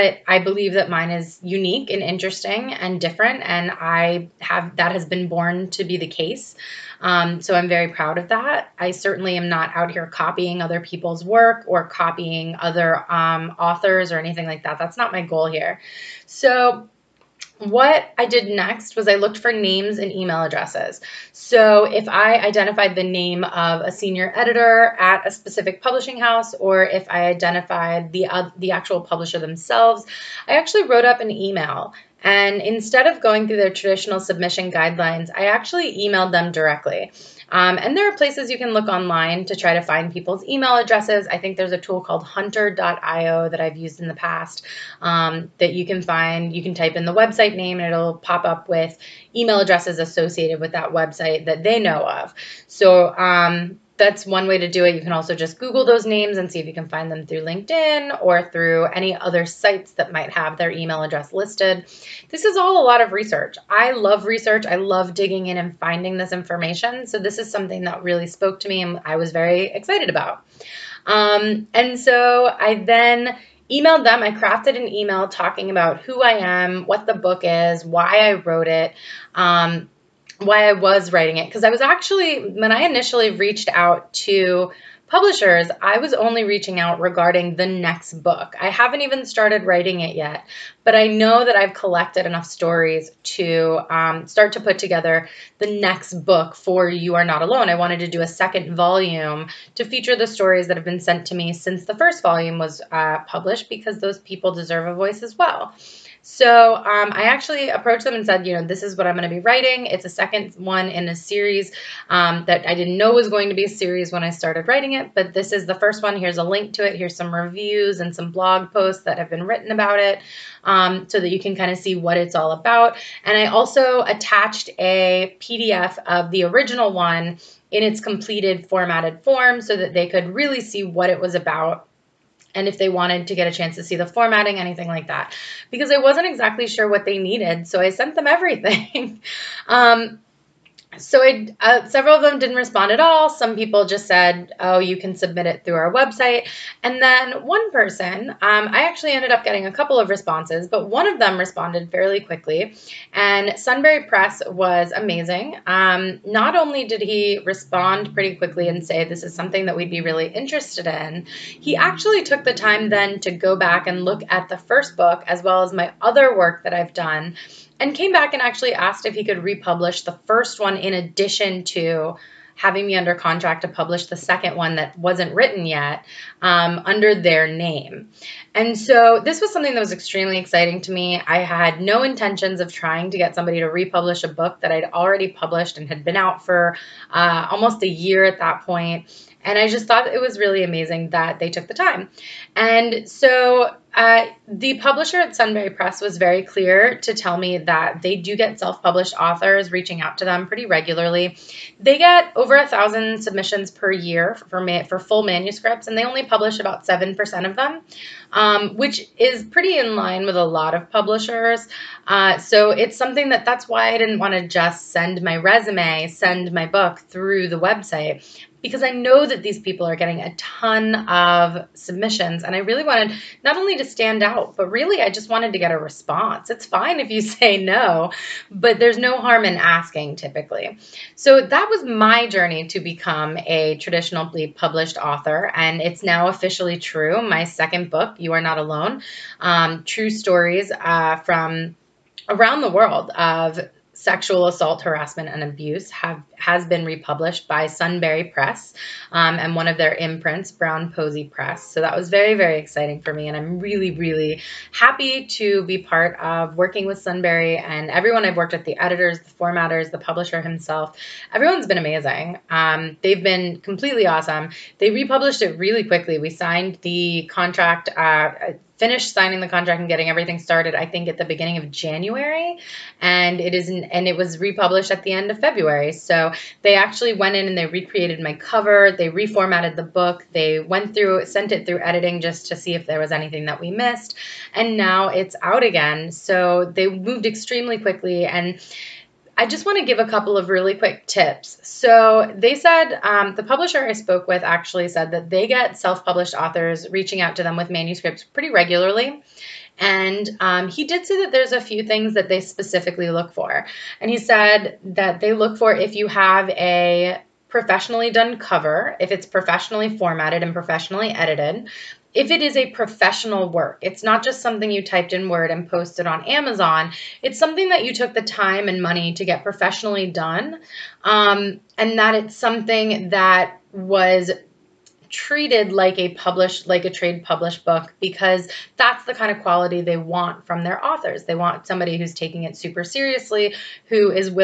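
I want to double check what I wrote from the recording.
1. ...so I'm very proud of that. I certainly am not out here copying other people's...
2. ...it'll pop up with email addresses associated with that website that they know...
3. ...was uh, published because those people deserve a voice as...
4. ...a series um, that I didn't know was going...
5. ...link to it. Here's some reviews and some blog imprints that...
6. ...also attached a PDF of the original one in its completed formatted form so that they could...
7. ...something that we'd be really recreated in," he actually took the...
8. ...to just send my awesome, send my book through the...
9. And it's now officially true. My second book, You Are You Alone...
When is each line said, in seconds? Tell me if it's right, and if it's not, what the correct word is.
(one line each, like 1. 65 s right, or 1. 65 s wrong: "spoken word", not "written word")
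1. 7 s right
2. 47 s right
3. 102 s right
4. 111 s right
5. 116 s wrong: "posts", not "imprints"
6. 123 s right
7. 159 s wrong: "interested", not "recreated"
8. 214 s wrong: "resume", not "awesome"
9. 235 s wrong: "Not", not "You".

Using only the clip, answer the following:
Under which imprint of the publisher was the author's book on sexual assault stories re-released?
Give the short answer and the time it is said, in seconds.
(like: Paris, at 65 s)
Brown Posey Press, at 250 s.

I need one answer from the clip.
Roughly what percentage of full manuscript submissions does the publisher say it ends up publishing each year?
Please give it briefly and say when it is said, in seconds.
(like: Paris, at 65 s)
7%, at 206 s.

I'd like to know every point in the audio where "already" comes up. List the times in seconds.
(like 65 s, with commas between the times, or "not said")
184 s.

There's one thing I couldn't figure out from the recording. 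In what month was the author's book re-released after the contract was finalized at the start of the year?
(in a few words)
February.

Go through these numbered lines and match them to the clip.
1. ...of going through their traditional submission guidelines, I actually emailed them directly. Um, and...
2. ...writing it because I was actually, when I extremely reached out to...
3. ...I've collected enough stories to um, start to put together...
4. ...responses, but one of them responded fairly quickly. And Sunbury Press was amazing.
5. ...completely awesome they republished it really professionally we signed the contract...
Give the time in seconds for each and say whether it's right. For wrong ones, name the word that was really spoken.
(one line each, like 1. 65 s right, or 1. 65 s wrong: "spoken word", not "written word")
1. 33 s right
2. 81 s wrong: "initially", not "extremely"
3. 91 s right
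4. 150 s right
5. 263 s wrong: "quickly", not "professionally".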